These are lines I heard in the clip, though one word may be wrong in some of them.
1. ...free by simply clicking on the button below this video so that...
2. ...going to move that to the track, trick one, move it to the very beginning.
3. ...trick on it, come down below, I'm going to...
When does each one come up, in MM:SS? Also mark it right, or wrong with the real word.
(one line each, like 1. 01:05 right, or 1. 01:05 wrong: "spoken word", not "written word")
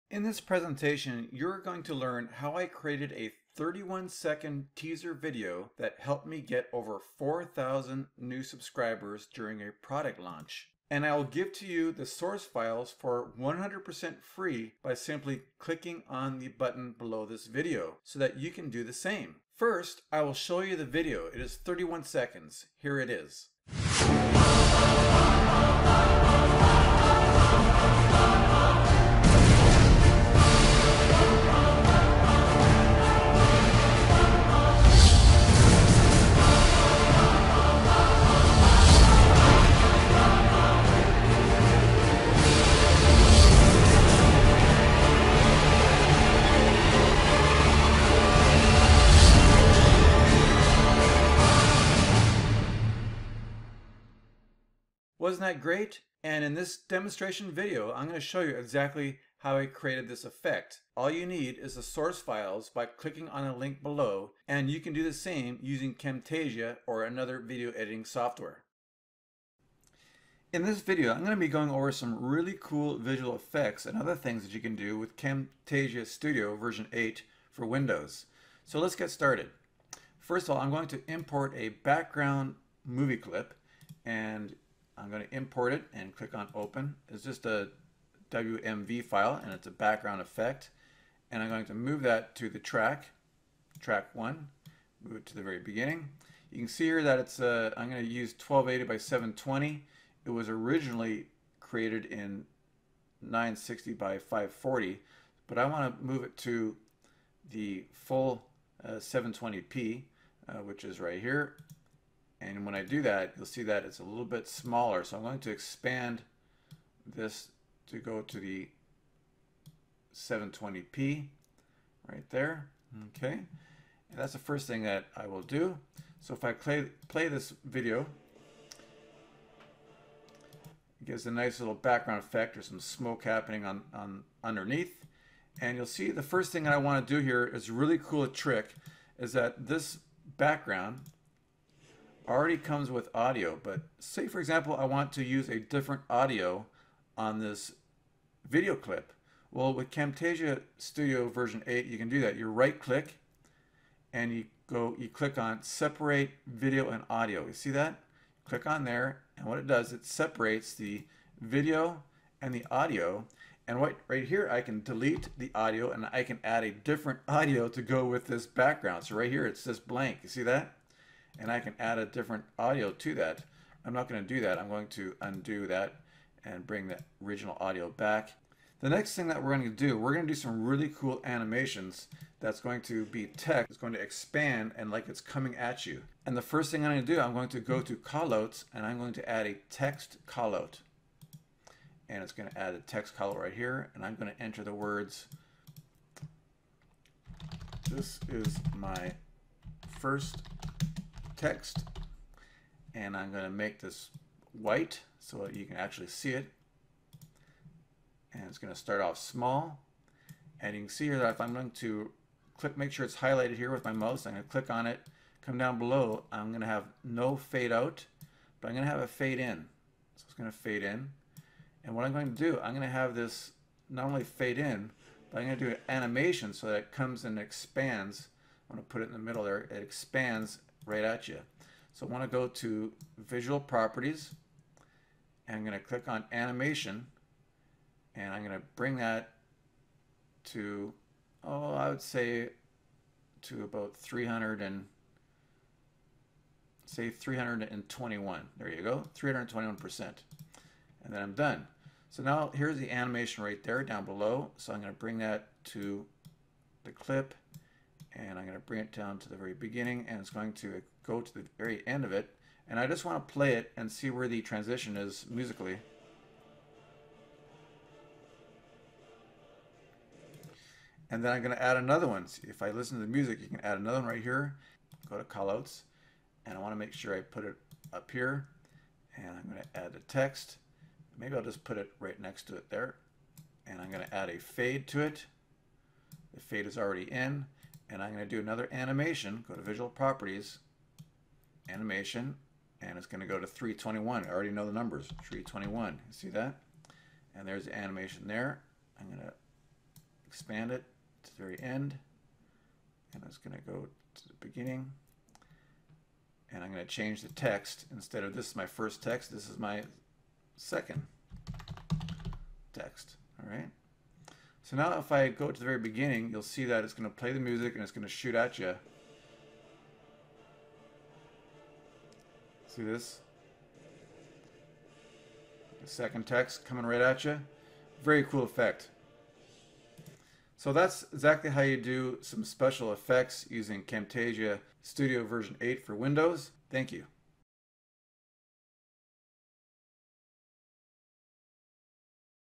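1. 00:14 right
2. 01:31 wrong: "track", not "trick"
3. 03:34 wrong: "click", not "trick".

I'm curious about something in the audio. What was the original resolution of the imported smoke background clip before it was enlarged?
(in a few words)
960 by 540.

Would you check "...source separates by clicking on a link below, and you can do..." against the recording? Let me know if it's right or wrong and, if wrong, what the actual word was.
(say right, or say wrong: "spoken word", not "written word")
wrong: "files", not "separates".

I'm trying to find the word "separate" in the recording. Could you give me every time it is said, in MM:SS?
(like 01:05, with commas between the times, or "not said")
02:35, 02:40.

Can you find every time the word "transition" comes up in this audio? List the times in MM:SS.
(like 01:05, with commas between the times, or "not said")
04:24.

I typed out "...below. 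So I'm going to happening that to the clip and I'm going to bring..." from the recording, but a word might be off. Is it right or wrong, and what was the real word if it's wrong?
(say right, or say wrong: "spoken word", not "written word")
wrong: "bring", not "happening".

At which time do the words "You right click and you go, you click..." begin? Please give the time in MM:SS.
02:32.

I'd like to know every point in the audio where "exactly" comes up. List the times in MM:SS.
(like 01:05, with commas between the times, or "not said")
00:58, 05:31.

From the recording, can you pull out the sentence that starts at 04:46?
The fade is already in and I'm going to do another animation.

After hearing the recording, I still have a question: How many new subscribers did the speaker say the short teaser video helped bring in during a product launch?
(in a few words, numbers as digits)
over 4,000.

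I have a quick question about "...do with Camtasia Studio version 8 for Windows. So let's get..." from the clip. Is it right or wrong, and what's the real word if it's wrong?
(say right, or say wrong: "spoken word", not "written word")
right.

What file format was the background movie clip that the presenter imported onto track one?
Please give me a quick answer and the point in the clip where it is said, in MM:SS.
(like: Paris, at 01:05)
WMV, at 01:28.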